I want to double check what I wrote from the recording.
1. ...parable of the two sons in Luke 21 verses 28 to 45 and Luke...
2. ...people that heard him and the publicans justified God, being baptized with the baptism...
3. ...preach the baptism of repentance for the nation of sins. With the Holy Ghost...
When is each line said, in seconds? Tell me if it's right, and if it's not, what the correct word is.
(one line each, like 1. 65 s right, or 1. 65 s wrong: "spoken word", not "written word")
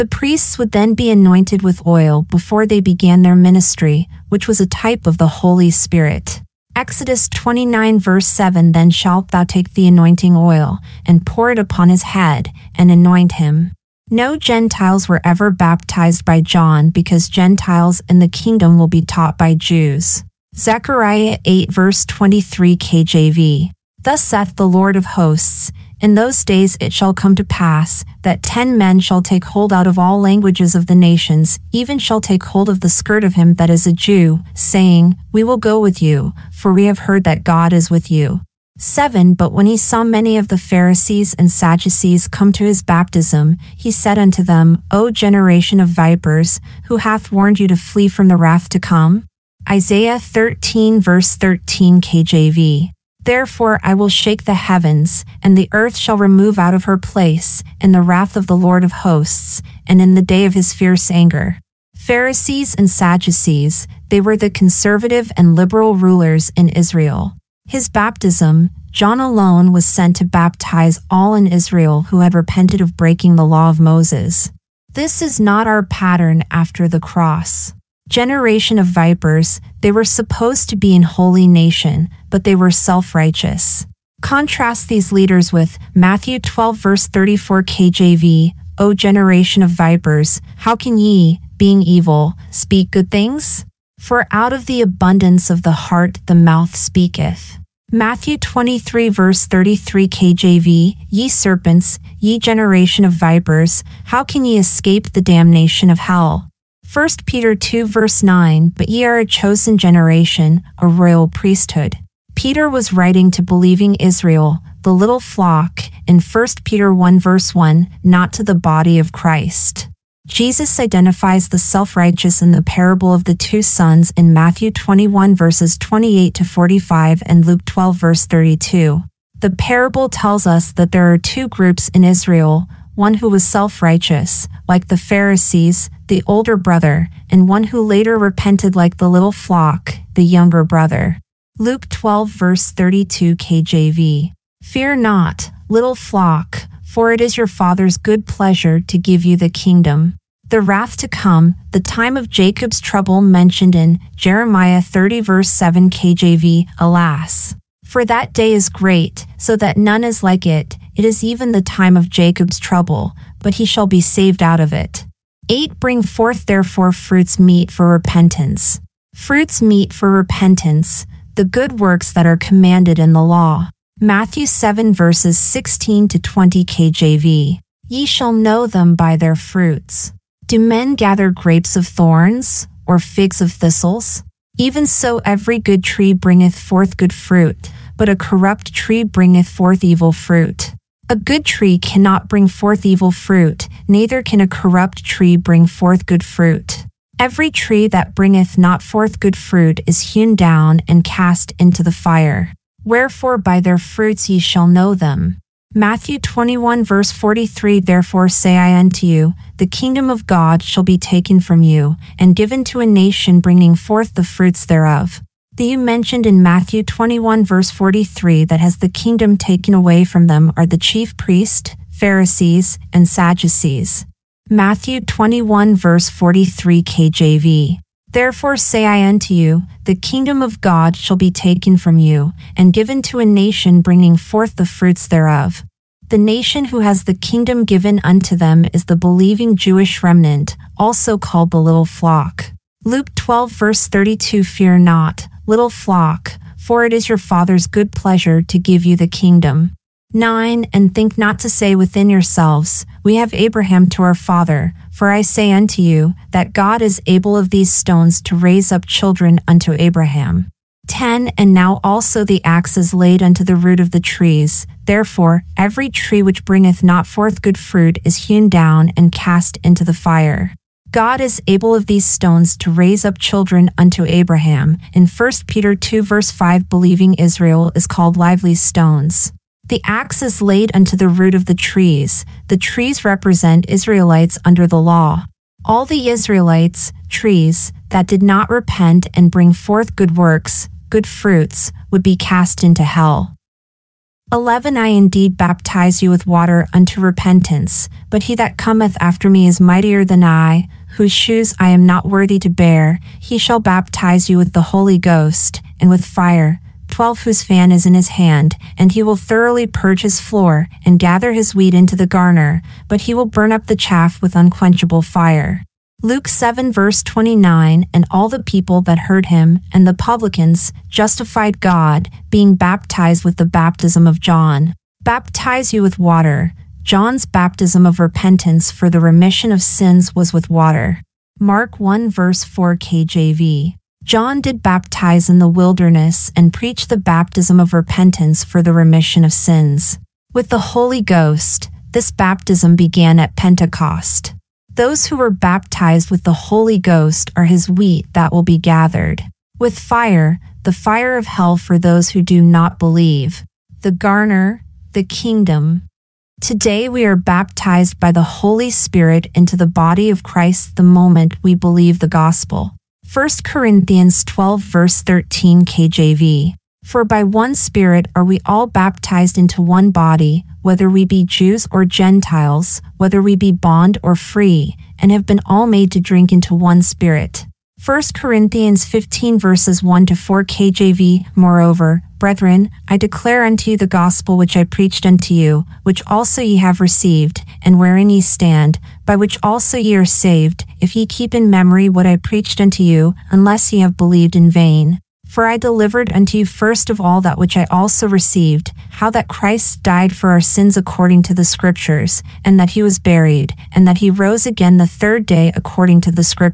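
1. 122 s wrong: "Matthew", not "Luke"
2. 318 s right
3. 336 s wrong: "remission", not "nation".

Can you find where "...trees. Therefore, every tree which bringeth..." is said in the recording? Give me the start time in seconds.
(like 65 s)
263 s.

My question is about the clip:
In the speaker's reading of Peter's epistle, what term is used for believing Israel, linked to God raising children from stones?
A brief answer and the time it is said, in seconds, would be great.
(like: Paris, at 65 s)
Lively stones, at 278 s.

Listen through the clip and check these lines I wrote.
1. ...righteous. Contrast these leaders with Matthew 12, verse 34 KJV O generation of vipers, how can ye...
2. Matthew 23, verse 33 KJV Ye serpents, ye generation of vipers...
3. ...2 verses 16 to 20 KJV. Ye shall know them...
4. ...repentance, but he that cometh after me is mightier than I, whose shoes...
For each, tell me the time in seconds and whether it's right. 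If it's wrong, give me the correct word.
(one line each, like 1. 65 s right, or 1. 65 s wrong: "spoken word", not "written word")
1. 83 s right
2. 97 s right
3. 174 s wrong: "7", not "2"
4. 296 s right.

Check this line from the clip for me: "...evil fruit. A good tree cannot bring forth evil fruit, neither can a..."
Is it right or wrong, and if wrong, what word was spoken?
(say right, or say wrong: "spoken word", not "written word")
right.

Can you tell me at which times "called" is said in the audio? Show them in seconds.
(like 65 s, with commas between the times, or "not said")
241 s, 277 s.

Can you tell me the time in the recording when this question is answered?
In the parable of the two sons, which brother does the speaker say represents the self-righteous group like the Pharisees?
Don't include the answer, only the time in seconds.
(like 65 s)
136 s.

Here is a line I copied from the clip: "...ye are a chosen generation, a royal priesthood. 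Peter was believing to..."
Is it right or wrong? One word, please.
wrong.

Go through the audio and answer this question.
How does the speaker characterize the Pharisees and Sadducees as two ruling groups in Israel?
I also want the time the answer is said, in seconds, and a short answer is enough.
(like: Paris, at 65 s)
Conservative and liberal rulers, at 64 s.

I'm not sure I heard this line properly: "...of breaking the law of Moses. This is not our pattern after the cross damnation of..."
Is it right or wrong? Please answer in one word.
wrong.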